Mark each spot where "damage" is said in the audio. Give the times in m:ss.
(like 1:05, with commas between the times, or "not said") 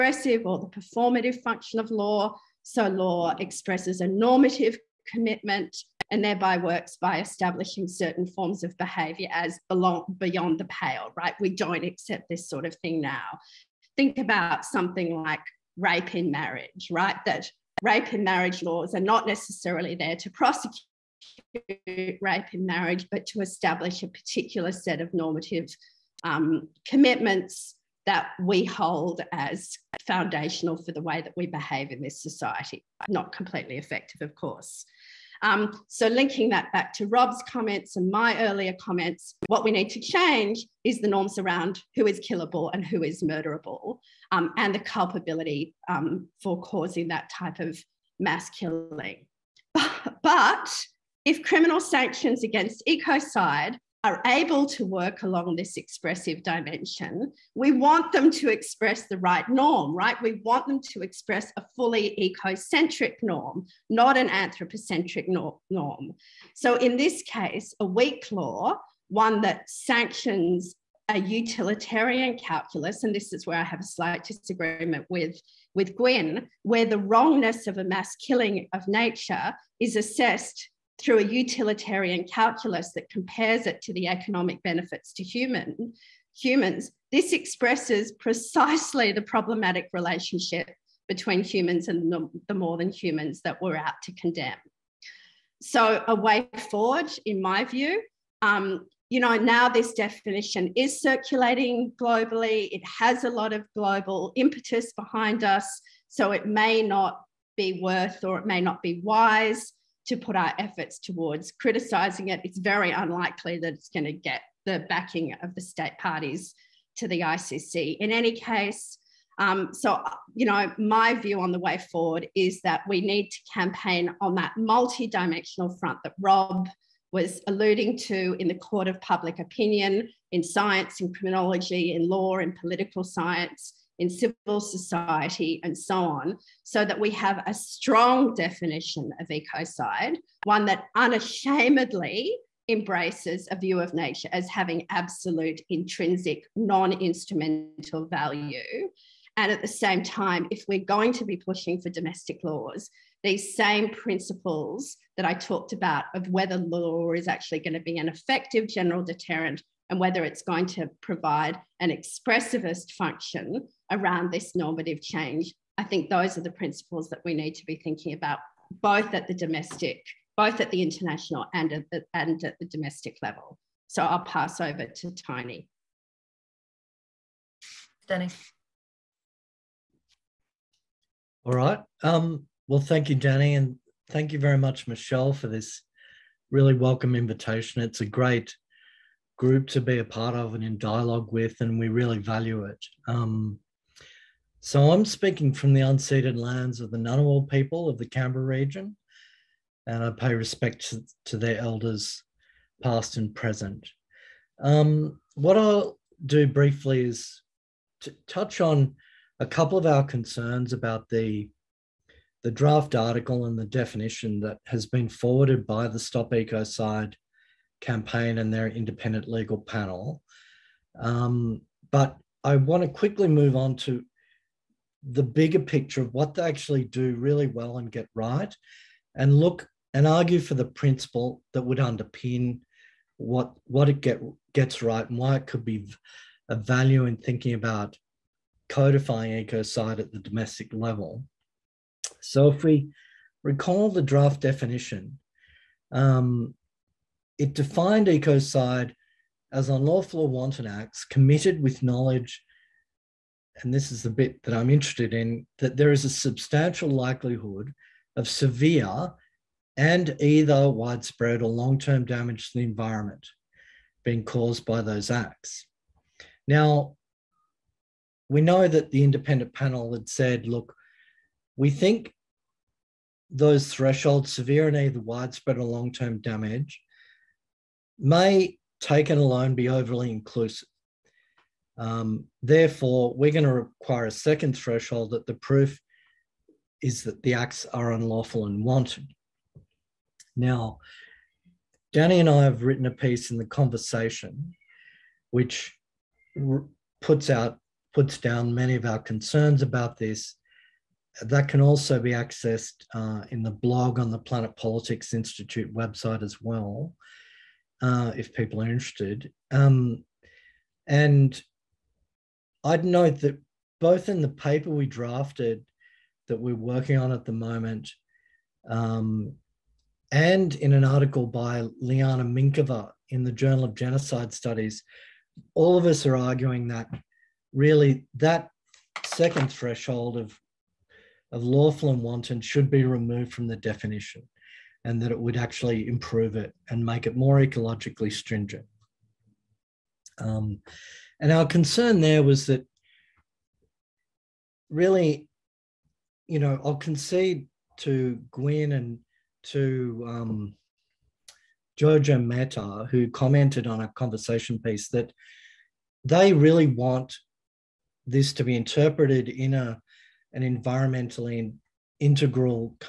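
4:22, 4:36.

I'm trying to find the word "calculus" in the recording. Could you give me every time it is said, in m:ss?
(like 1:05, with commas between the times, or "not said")
1:12, 1:22.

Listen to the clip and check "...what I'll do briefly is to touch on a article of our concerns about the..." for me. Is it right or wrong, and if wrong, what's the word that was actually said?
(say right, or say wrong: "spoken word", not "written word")
wrong: "couple", not "article".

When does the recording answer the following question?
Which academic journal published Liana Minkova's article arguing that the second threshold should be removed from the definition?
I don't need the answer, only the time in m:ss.
5:23.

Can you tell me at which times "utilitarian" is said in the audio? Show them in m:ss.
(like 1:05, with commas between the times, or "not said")
1:11, 1:21.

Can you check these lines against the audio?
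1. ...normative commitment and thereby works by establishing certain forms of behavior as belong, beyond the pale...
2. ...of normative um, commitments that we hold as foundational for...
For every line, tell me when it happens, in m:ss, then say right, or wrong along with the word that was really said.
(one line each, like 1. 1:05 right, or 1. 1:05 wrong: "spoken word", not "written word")
1. 0:04 right
2. 0:24 right.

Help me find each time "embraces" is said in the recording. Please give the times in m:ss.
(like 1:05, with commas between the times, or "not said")
2:22.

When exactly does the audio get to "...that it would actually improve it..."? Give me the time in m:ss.
5:35.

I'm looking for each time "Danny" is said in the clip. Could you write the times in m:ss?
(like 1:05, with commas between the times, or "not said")
2:58, 3:03, 4:51.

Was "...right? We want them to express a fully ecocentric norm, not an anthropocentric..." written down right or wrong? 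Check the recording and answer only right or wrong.
right.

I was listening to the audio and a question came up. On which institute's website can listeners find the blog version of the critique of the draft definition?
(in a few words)
Planet Politics Institute.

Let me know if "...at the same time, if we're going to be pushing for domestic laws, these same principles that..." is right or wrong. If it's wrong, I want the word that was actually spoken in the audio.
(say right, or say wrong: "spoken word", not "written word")
right.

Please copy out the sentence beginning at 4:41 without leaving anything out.
Um, therefore, we're going to require a second threshold that the proof is that the acts are unlawful and wanton.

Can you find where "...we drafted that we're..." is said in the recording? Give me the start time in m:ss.
5:14.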